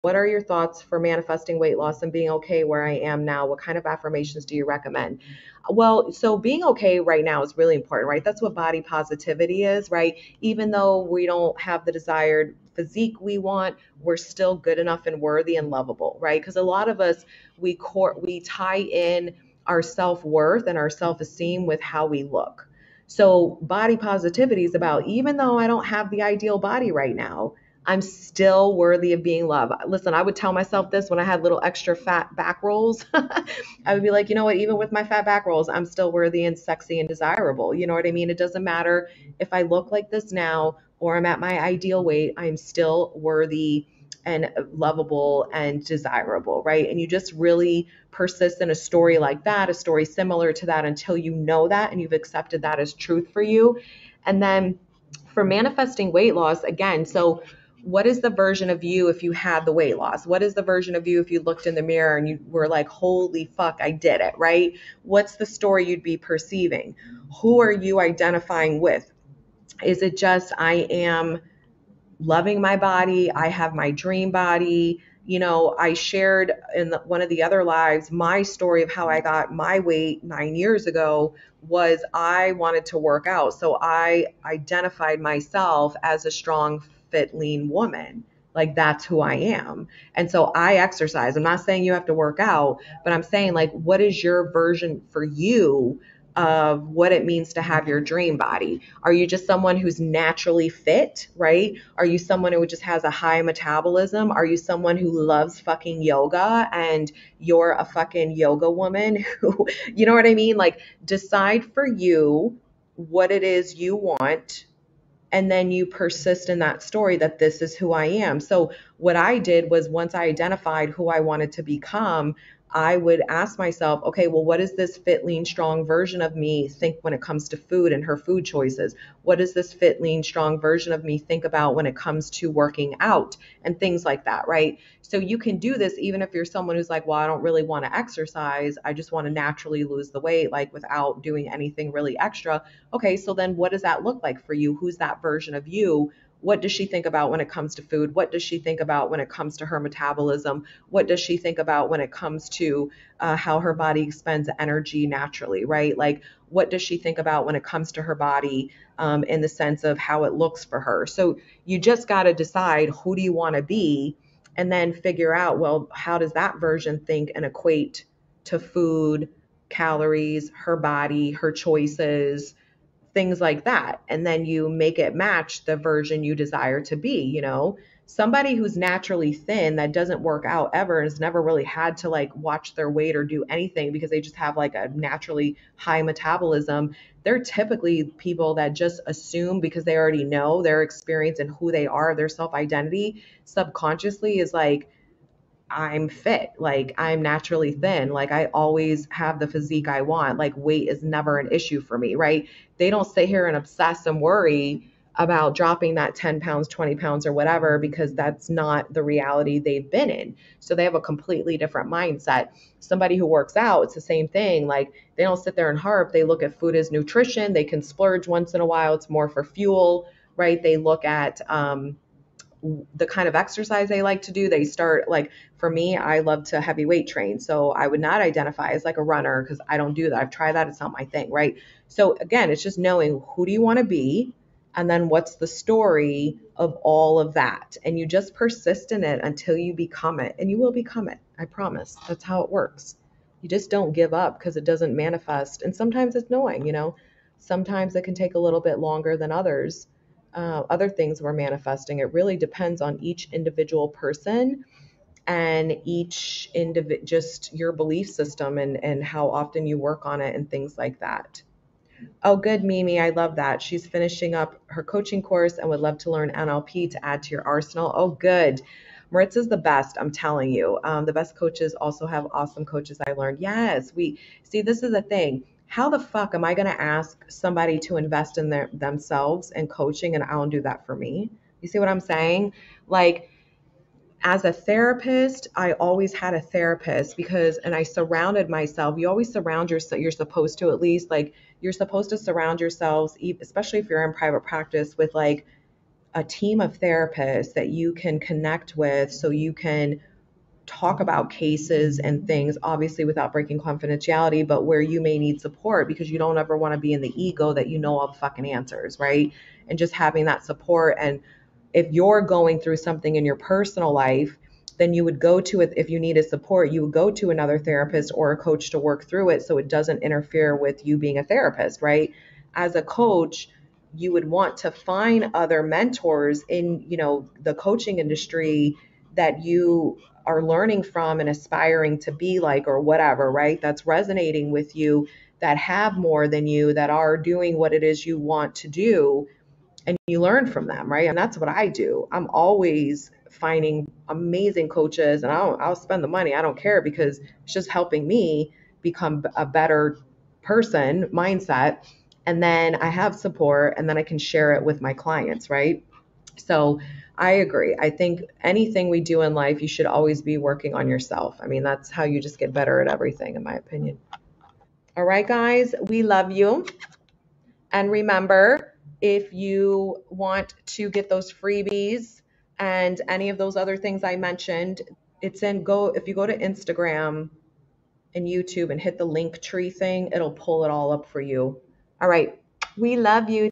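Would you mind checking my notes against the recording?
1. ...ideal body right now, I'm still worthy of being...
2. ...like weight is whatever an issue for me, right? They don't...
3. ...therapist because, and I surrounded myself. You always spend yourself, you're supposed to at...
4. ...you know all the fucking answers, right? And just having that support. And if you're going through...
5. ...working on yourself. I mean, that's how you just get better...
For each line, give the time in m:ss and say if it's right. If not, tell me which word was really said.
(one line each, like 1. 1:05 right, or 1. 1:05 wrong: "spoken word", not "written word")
1. 0:26 right
2. 3:20 wrong: "never", not "whatever"
3. 4:46 wrong: "surround", not "spend"
4. 5:07 right
5. 6:00 right.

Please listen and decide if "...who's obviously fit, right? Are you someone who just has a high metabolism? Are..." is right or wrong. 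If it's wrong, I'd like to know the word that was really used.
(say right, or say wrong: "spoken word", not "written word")
wrong: "naturally", not "obviously".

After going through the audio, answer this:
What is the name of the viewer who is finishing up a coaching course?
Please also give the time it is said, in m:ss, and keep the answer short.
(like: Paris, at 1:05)
Mimi, at 4:22.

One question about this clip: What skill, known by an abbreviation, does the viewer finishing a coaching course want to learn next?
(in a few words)
NLP.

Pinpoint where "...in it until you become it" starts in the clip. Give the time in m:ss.
3:58.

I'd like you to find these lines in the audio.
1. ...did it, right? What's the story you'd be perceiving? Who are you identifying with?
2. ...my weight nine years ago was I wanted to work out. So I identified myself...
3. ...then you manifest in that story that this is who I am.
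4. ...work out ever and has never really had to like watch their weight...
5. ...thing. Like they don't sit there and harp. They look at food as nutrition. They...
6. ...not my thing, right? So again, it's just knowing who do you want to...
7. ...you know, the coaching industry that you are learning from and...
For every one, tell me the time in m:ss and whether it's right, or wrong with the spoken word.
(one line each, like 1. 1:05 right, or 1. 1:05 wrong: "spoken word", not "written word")
1. 1:03 right
2. 1:19 right
3. 1:55 wrong: "persist", not "manifest"
4. 3:00 right
5. 3:34 right
6. 3:50 right
7. 5:26 right.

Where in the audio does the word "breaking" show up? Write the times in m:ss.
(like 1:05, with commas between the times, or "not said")
5:03.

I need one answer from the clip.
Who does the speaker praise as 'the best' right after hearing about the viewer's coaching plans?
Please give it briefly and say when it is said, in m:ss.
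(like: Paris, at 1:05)
Maritz, at 4:29.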